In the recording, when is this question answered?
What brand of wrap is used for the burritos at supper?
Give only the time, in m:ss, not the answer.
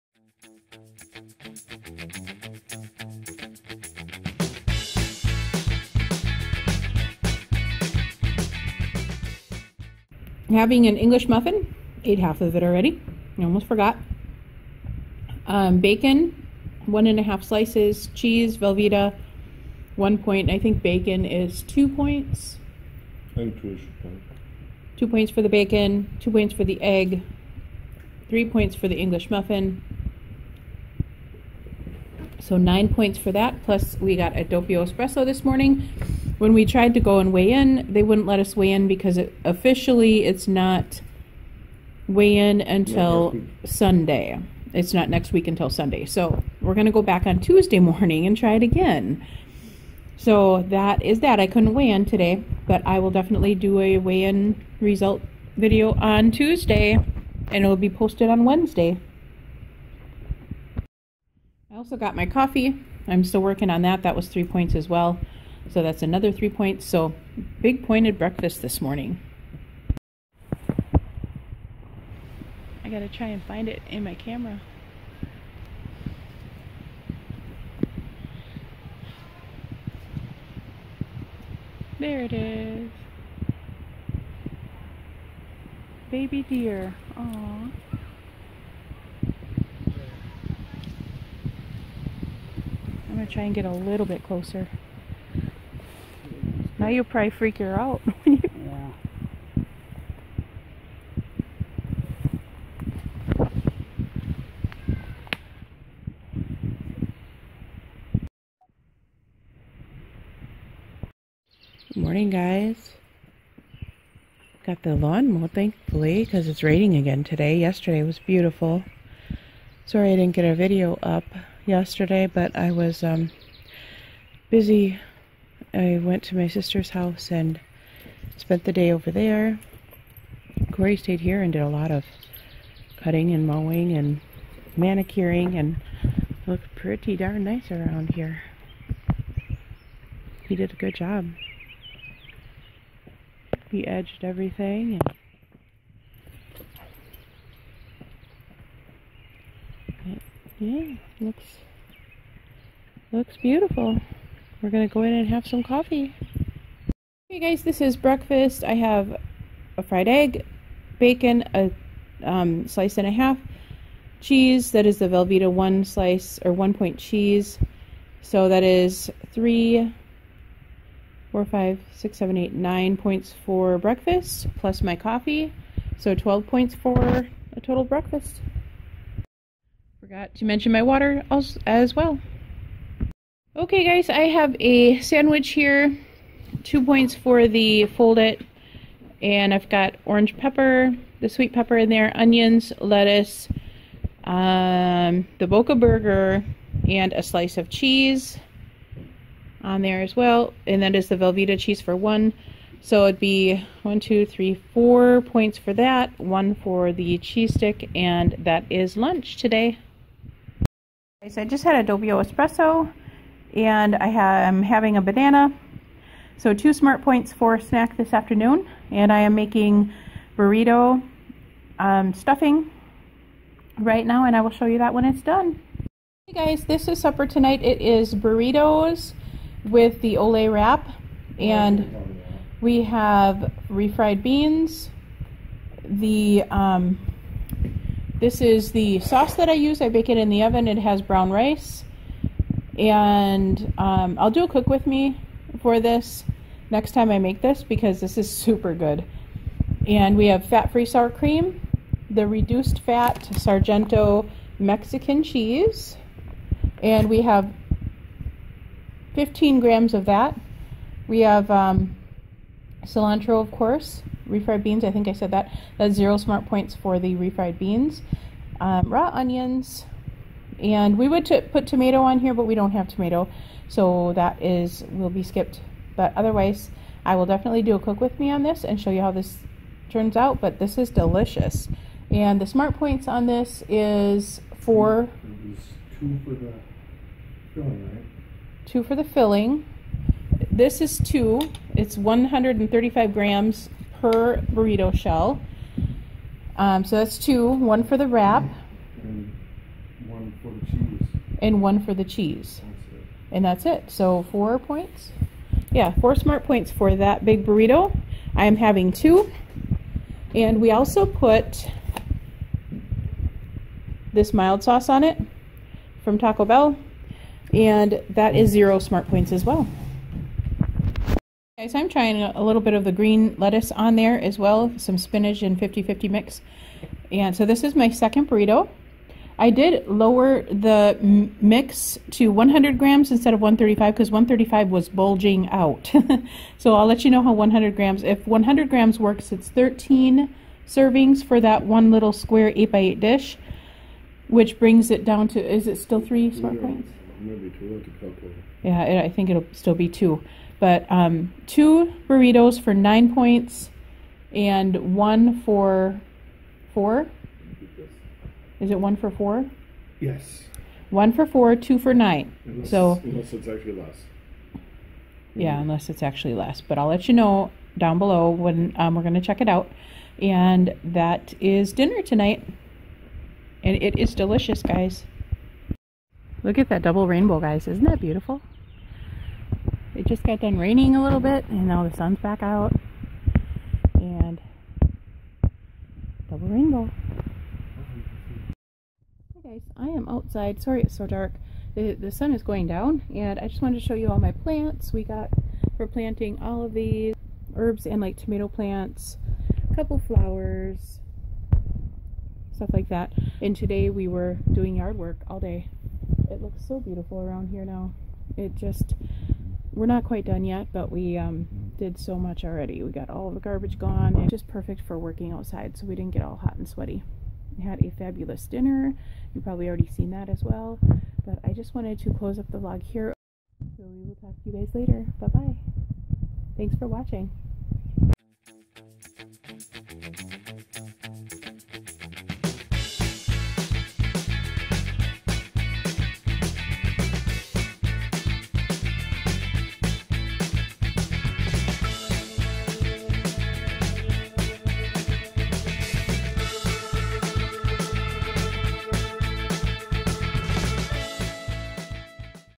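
3:50.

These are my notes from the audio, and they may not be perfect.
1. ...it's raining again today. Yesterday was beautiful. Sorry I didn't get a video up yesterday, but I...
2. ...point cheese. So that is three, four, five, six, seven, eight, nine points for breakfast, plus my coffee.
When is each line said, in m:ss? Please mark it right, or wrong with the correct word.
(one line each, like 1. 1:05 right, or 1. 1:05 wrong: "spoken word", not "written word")
1. 1:56 right
2. 2:46 right.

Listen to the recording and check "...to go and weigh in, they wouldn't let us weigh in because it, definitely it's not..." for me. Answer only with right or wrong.
wrong.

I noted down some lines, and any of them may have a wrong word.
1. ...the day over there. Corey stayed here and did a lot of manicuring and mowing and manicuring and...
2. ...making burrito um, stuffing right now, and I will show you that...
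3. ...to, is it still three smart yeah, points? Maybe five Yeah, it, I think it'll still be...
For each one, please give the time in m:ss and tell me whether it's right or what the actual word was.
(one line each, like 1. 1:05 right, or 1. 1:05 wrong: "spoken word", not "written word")
1. 2:08 wrong: "cutting", not "manicuring"
2. 3:39 right
3. 5:45 wrong: "two", not "five".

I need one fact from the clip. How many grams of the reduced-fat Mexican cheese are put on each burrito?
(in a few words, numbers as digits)
15 grams.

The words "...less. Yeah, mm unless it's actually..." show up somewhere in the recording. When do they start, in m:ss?
6:03.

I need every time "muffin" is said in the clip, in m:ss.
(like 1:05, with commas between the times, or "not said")
0:11, 0:29.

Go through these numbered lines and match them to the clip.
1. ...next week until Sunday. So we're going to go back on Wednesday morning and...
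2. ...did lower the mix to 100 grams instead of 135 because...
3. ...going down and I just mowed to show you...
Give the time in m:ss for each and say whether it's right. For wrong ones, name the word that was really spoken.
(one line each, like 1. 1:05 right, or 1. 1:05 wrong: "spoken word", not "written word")
1. 0:45 wrong: "Tuesday", not "Wednesday"
2. 5:29 right
3. 6:32 wrong: "wanted", not "mowed".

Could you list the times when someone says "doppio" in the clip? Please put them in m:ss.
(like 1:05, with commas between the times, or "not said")
0:34, 3:31.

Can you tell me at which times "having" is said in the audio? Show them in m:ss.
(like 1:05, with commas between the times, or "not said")
0:10, 3:34, 5:08.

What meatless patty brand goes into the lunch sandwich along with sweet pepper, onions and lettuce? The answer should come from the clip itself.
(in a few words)
Boca Burger.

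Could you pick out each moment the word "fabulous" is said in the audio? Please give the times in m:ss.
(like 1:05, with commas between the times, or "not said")
6:57.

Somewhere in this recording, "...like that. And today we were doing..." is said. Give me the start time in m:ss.
6:42.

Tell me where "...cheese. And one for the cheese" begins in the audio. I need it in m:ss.
5:00.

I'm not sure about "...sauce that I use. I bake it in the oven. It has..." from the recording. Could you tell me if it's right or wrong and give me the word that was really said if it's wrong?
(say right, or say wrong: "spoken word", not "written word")
right.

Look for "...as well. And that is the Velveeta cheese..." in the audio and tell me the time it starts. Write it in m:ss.
3:20.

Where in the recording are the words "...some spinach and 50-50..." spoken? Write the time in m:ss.
5:24.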